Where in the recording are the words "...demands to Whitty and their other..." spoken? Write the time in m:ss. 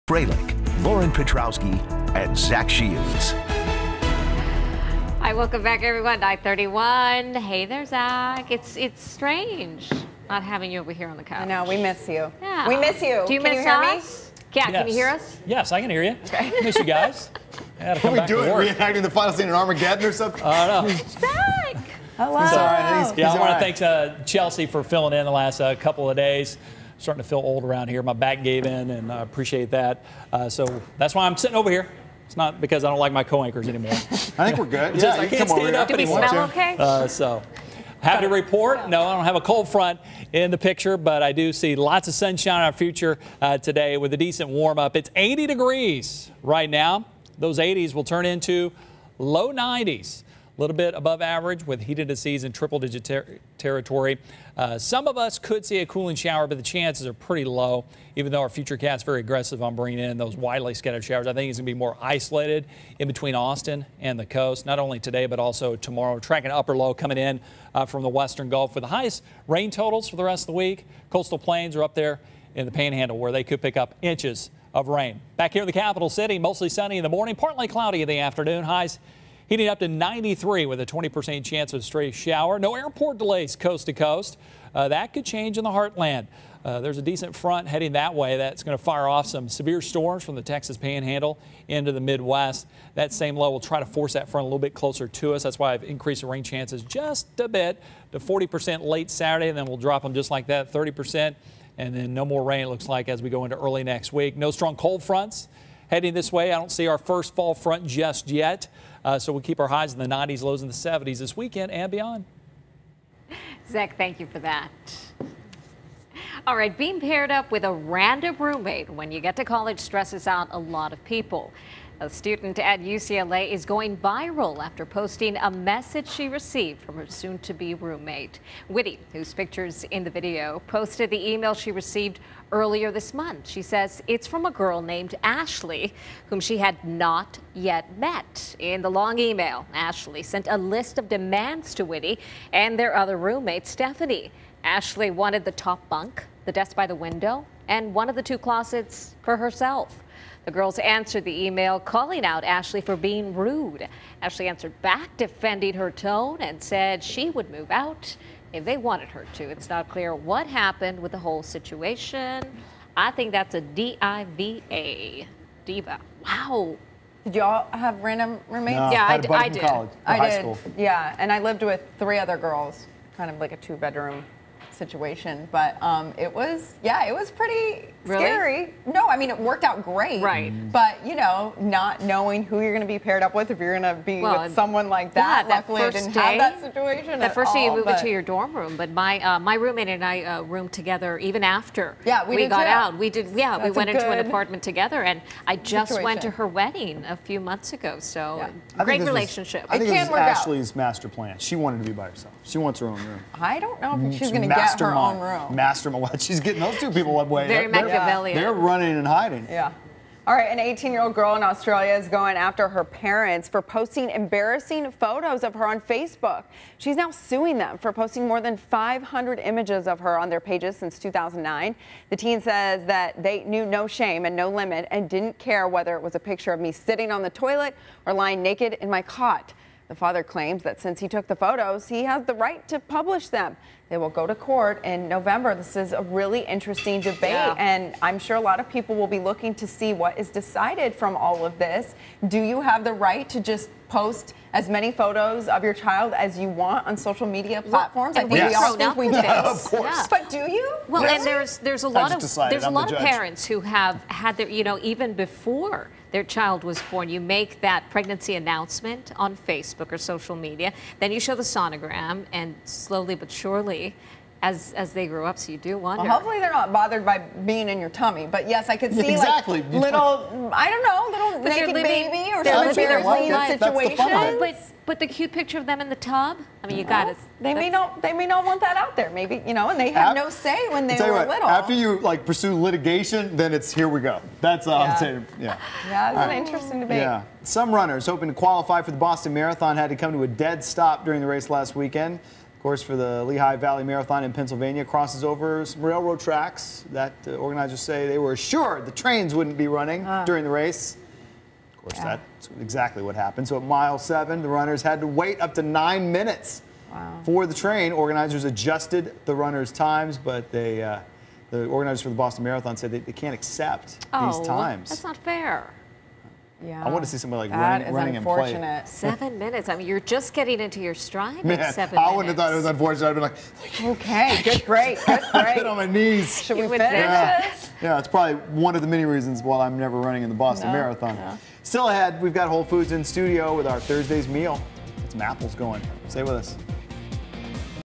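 2:21.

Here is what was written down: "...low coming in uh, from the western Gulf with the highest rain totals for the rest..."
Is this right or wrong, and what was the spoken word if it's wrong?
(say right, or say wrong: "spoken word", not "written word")
right.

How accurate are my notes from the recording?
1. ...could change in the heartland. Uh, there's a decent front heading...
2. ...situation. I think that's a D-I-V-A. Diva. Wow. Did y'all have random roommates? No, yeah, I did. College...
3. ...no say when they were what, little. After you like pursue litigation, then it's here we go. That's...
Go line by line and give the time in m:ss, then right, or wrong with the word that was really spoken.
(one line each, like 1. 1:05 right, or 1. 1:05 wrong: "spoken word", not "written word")
1. 1:25 right
2. 2:41 right
3. 4:40 right.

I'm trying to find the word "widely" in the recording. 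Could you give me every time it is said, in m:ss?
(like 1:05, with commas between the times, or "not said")
1:00.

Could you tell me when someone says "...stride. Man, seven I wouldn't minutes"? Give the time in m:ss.
5:20.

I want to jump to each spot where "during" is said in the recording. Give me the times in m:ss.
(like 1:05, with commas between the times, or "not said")
4:51, 5:00.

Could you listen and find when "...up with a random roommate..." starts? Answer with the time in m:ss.
1:57.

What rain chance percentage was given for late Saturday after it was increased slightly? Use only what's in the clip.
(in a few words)
40%.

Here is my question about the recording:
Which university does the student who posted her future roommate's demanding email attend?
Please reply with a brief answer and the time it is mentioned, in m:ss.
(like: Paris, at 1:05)
UCLA, at 2:02.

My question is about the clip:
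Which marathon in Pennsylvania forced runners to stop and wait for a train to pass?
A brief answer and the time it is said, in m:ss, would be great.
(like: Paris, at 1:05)
Lehigh Valley Marathon, at 4:53.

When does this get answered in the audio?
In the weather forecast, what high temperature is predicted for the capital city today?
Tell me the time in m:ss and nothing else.
1:19.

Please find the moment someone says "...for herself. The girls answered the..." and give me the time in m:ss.
2:29.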